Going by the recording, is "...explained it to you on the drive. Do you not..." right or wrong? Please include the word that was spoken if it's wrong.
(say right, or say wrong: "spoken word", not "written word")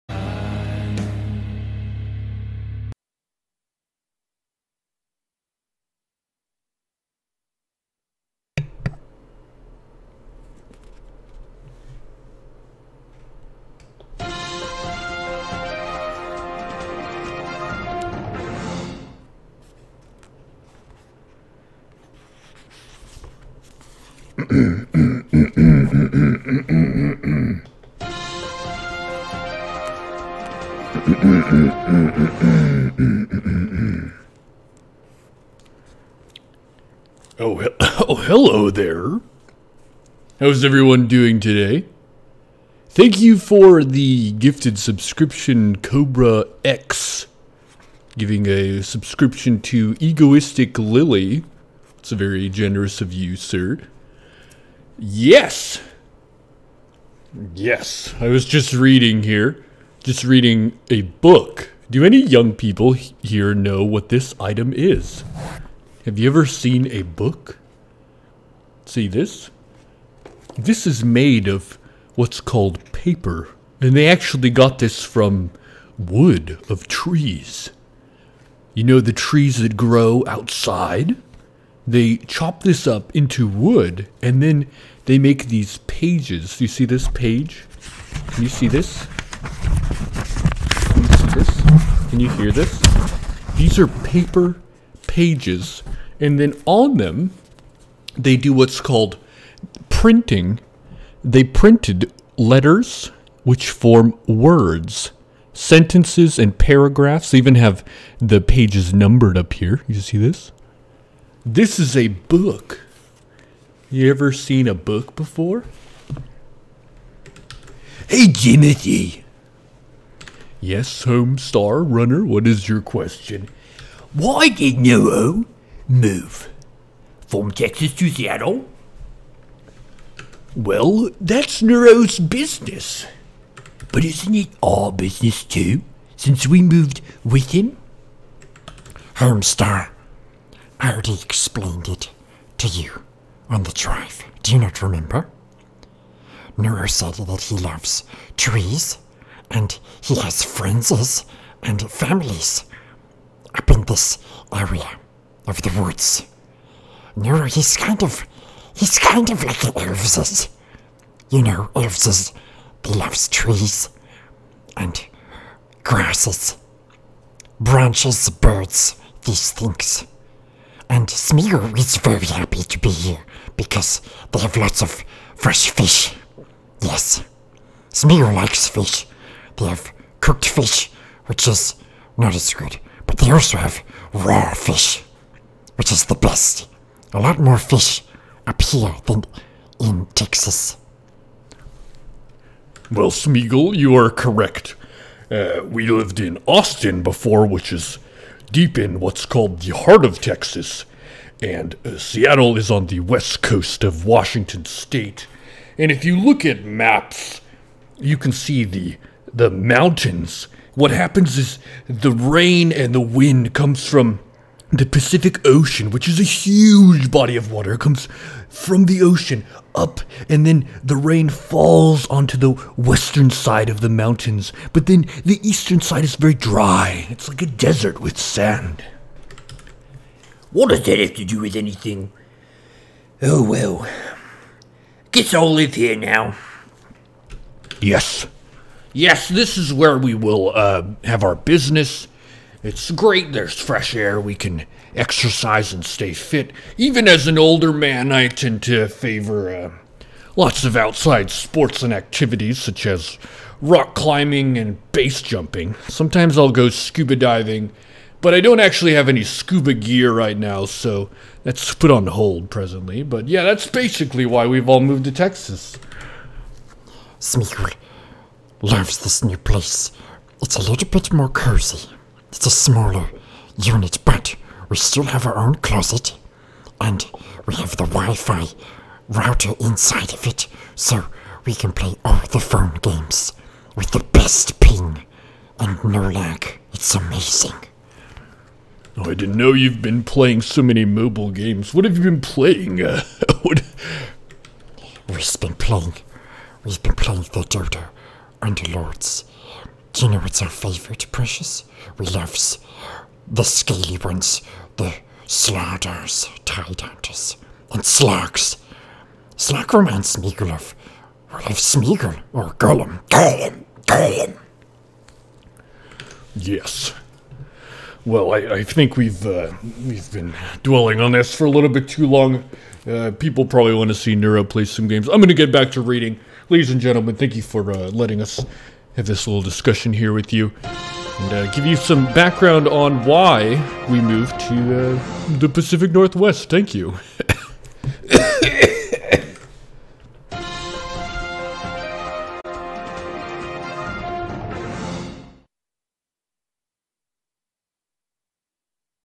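right.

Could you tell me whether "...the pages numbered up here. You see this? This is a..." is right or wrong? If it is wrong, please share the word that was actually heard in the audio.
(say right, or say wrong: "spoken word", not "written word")
right.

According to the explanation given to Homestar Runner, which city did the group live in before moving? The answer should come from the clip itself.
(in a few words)
Austin.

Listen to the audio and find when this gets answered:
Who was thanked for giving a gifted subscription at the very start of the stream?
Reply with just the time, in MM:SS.
00:45.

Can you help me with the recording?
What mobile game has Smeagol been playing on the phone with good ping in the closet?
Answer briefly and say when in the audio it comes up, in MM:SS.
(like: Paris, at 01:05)
Dota Underlords, at 04:57.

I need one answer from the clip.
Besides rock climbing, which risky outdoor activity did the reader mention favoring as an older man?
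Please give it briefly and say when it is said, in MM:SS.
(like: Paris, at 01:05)
base jumping, at 04:14.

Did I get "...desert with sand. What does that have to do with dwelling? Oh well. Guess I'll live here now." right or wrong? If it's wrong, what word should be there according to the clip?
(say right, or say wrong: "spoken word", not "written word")
wrong: "anything", not "dwelling".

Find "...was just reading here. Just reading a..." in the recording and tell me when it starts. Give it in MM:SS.
00:58.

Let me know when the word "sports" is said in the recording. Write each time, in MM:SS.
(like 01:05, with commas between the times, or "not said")
04:11.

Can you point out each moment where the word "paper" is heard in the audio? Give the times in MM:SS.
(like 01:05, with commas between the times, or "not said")
01:12, 01:33.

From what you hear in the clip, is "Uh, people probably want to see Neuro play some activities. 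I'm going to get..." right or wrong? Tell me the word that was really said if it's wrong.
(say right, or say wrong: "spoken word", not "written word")
wrong: "games", not "activities".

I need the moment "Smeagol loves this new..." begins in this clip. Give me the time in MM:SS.
04:27.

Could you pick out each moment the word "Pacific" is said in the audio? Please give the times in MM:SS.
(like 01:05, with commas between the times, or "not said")
03:34, 05:35.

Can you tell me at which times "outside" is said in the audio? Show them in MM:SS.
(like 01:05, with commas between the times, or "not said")
01:20, 04:10.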